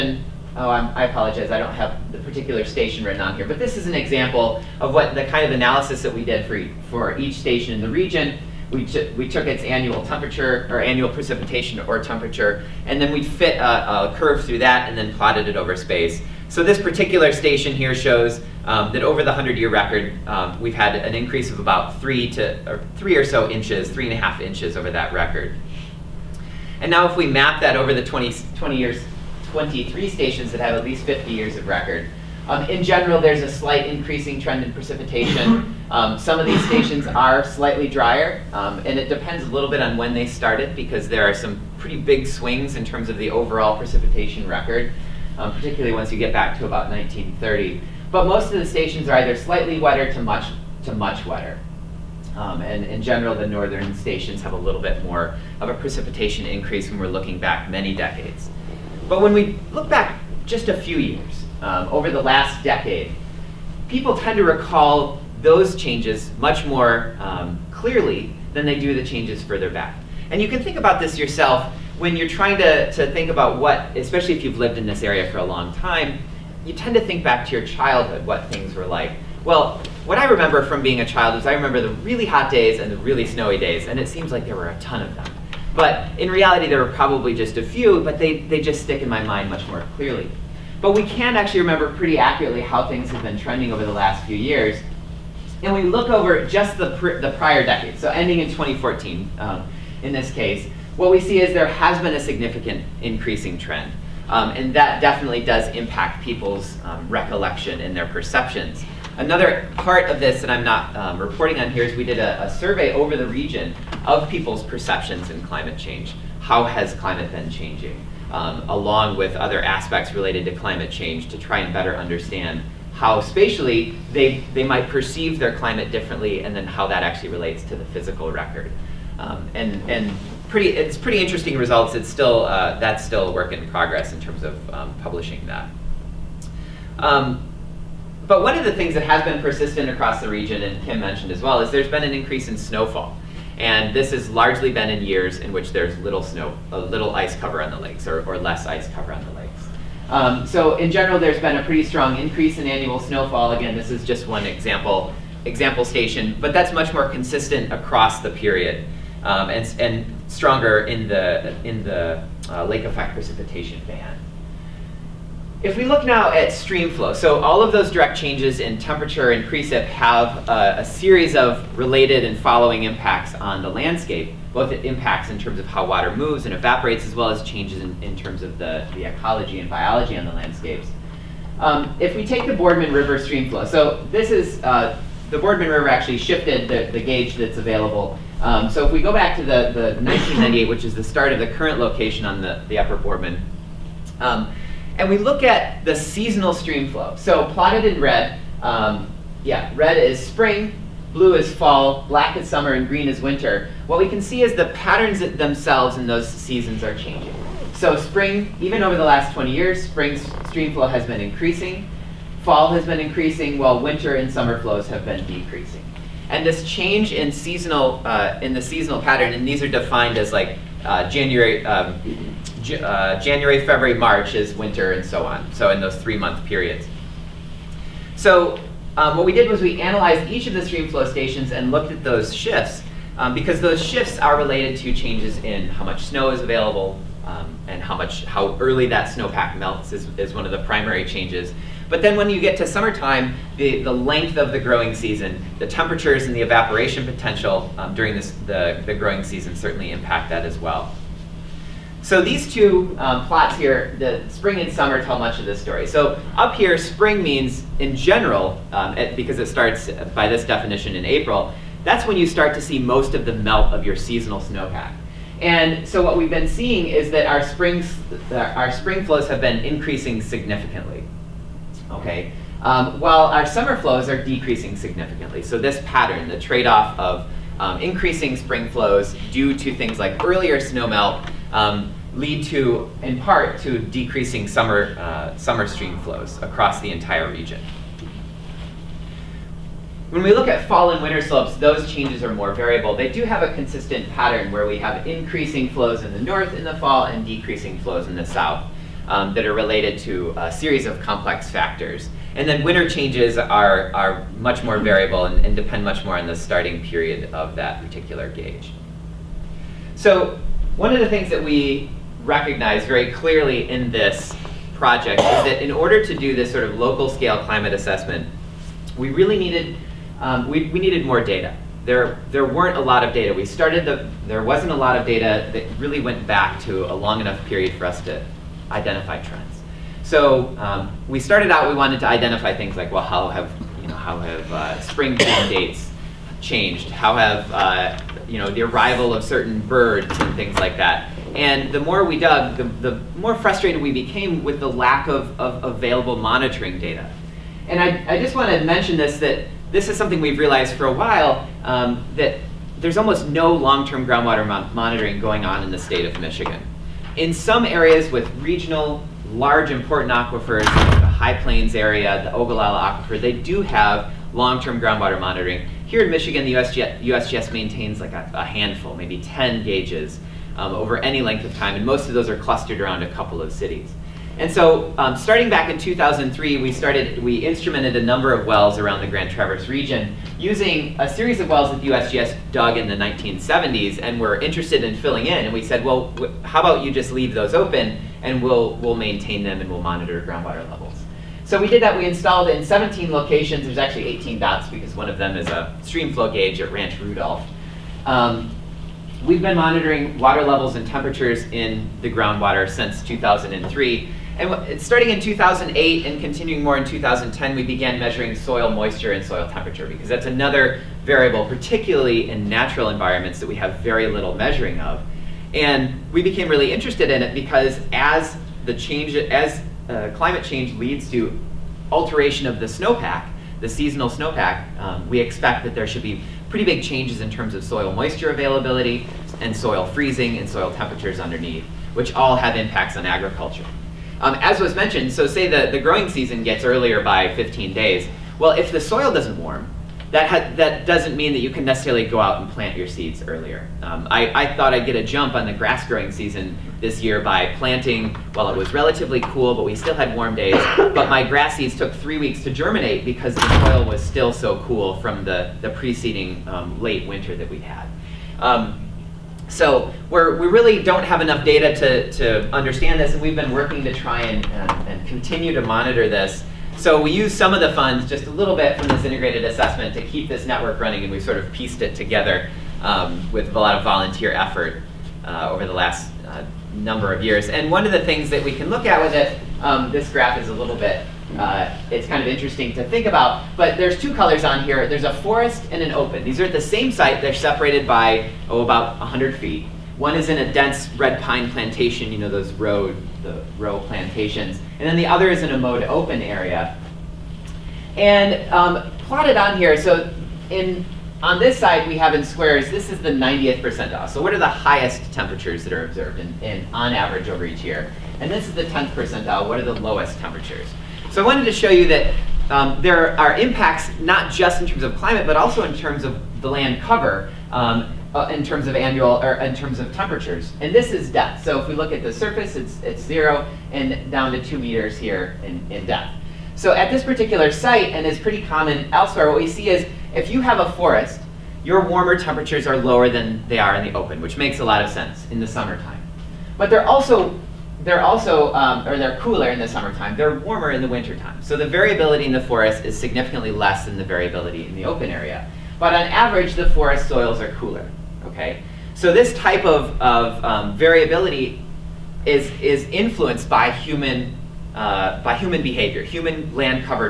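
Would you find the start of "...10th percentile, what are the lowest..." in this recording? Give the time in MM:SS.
08:28.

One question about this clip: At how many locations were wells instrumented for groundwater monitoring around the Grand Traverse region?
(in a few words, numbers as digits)
17.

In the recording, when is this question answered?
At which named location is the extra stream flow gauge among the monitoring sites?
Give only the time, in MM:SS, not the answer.
06:36.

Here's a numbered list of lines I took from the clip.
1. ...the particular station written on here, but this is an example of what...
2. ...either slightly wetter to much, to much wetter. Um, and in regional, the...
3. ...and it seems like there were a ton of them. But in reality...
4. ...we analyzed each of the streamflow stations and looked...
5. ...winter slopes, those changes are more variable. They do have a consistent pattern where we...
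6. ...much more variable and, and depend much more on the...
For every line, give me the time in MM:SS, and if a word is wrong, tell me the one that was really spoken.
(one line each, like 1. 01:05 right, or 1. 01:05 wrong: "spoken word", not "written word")
1. 00:02 right
2. 00:49 wrong: "general", not "regional"
3. 01:23 right
4. 03:49 right
5. 04:51 right
6. 05:04 right.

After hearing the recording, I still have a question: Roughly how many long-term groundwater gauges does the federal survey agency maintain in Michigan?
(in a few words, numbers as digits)
10.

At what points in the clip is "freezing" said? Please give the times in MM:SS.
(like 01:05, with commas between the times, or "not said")
07:09.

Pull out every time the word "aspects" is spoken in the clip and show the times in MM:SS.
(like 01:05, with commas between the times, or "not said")
01:59.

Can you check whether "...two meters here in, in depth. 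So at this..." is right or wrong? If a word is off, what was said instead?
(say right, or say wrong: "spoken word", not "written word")
right.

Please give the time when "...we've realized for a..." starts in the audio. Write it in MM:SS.
05:50.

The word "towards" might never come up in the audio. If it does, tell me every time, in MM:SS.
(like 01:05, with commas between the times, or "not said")
not said.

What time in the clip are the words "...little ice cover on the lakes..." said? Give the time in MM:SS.
02:26.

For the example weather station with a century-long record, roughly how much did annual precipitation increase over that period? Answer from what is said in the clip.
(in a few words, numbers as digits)
3.5 inches.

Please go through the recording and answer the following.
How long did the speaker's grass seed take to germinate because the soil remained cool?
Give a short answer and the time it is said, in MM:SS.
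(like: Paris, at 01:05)
3 weeks, at 07:31.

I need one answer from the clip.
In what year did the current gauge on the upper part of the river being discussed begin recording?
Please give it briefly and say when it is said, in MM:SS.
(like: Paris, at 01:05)
1998, at 03:10.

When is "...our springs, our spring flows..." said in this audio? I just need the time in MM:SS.
04:27.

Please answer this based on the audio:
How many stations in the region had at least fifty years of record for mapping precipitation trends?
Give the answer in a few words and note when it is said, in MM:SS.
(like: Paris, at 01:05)
23, at 00:29.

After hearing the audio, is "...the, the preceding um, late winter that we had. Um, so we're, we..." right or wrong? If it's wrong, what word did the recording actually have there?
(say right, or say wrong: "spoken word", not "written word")
right.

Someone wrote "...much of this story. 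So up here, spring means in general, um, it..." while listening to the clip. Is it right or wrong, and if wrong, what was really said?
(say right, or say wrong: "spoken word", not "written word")
right.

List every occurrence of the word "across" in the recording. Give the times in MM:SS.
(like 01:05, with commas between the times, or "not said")
02:19, 02:37, 04:46.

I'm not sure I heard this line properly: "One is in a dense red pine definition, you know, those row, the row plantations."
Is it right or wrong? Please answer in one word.
wrong.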